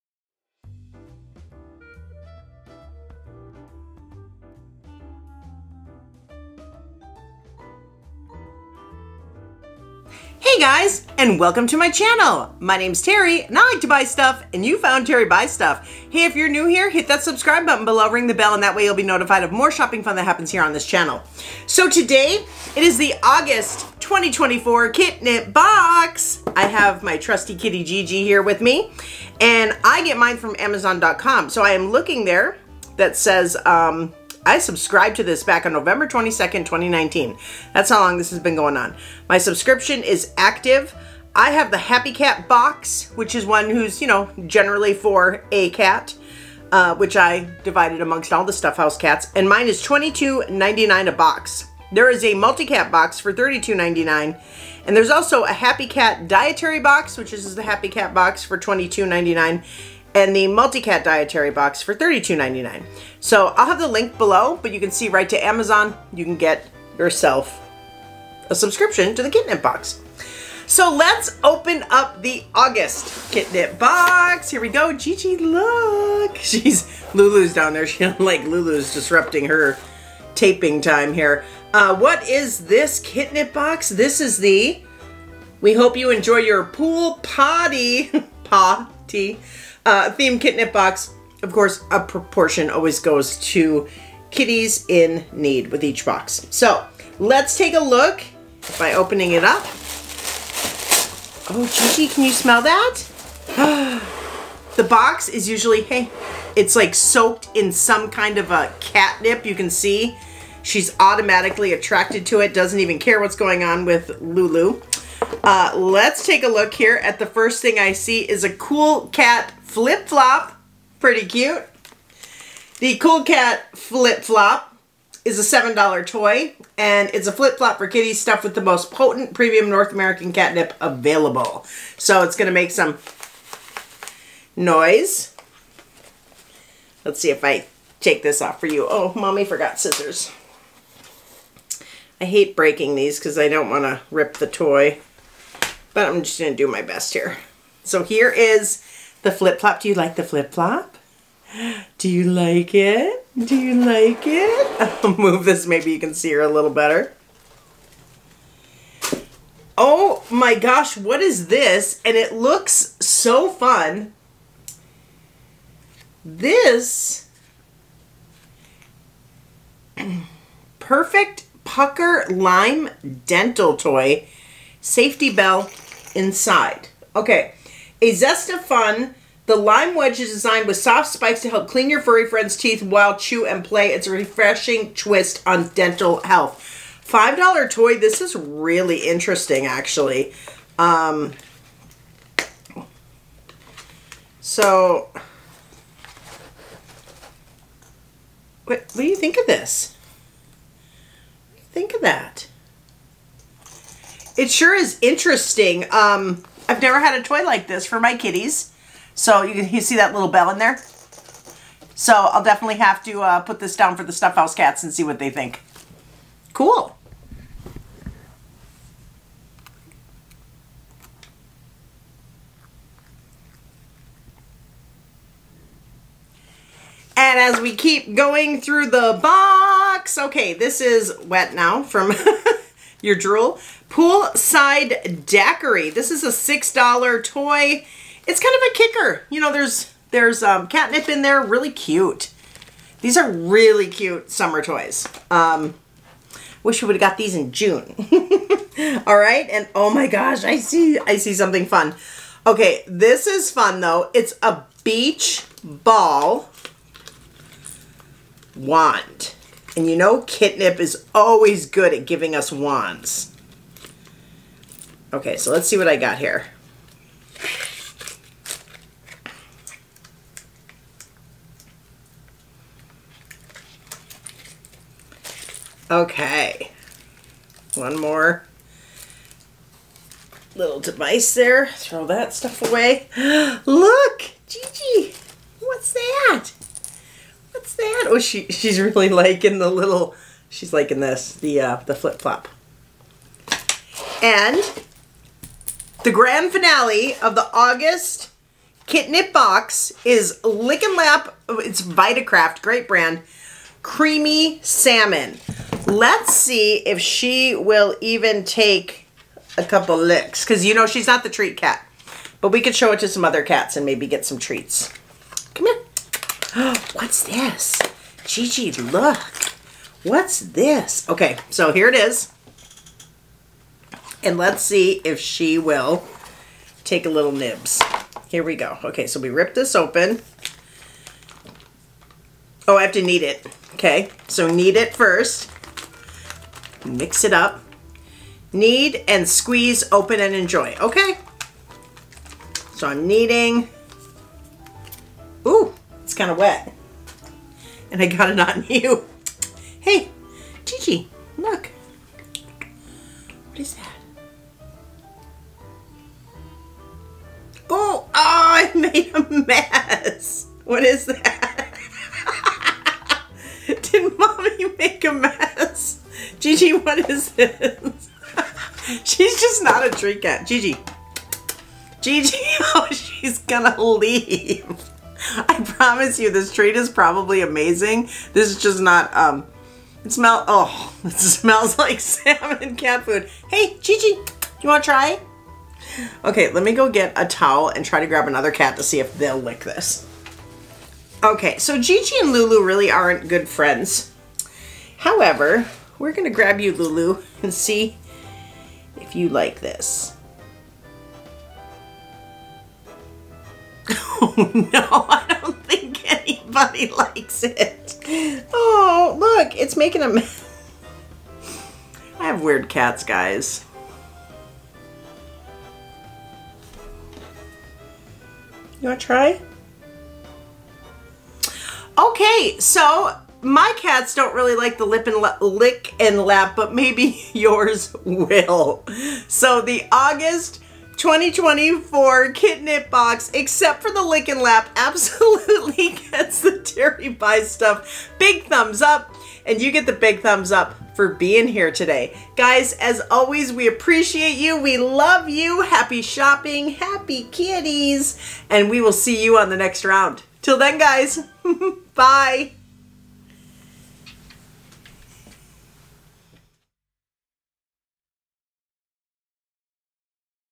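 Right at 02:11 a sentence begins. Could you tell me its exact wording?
So it's going to make some noise.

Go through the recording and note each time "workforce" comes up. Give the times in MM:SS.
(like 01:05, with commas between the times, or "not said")
not said.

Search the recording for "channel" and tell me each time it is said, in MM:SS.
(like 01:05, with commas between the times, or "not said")
00:11, 00:20.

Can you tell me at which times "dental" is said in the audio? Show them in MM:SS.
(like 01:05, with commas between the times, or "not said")
02:53, 03:05.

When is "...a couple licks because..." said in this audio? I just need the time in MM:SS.
05:09.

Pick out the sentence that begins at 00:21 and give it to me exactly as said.
So today, it is the August 2024 Kitnip Box.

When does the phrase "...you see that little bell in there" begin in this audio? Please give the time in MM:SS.
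03:29.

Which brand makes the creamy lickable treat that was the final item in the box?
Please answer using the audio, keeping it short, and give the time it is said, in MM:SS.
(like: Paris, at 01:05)
Vitakraft, at 05:01.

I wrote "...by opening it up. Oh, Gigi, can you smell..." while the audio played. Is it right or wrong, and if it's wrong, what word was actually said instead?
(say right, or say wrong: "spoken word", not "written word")
right.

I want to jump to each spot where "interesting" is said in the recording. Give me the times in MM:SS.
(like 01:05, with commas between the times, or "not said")
03:09, 03:25.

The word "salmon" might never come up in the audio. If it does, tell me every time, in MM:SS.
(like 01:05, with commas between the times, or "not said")
05:04, 06:21.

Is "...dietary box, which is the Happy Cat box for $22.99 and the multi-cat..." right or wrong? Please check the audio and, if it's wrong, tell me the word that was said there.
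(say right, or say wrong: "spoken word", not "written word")
right.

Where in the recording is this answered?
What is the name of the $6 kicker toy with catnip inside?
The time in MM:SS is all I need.
03:53.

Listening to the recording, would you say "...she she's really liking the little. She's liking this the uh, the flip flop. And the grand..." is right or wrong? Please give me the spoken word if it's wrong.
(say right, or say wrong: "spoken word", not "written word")
right.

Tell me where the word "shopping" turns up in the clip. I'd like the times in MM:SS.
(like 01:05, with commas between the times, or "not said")
00:19, 07:26.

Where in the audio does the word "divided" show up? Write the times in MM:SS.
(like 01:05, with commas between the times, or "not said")
00:47.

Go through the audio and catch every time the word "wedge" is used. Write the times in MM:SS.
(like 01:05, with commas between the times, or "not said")
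02:59.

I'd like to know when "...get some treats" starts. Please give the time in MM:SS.
05:14.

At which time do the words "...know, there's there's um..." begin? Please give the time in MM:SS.
03:59.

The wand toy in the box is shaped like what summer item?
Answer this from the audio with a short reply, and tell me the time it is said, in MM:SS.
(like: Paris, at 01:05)
beach ball, at 04:14.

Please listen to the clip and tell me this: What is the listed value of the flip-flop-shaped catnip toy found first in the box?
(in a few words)
$7.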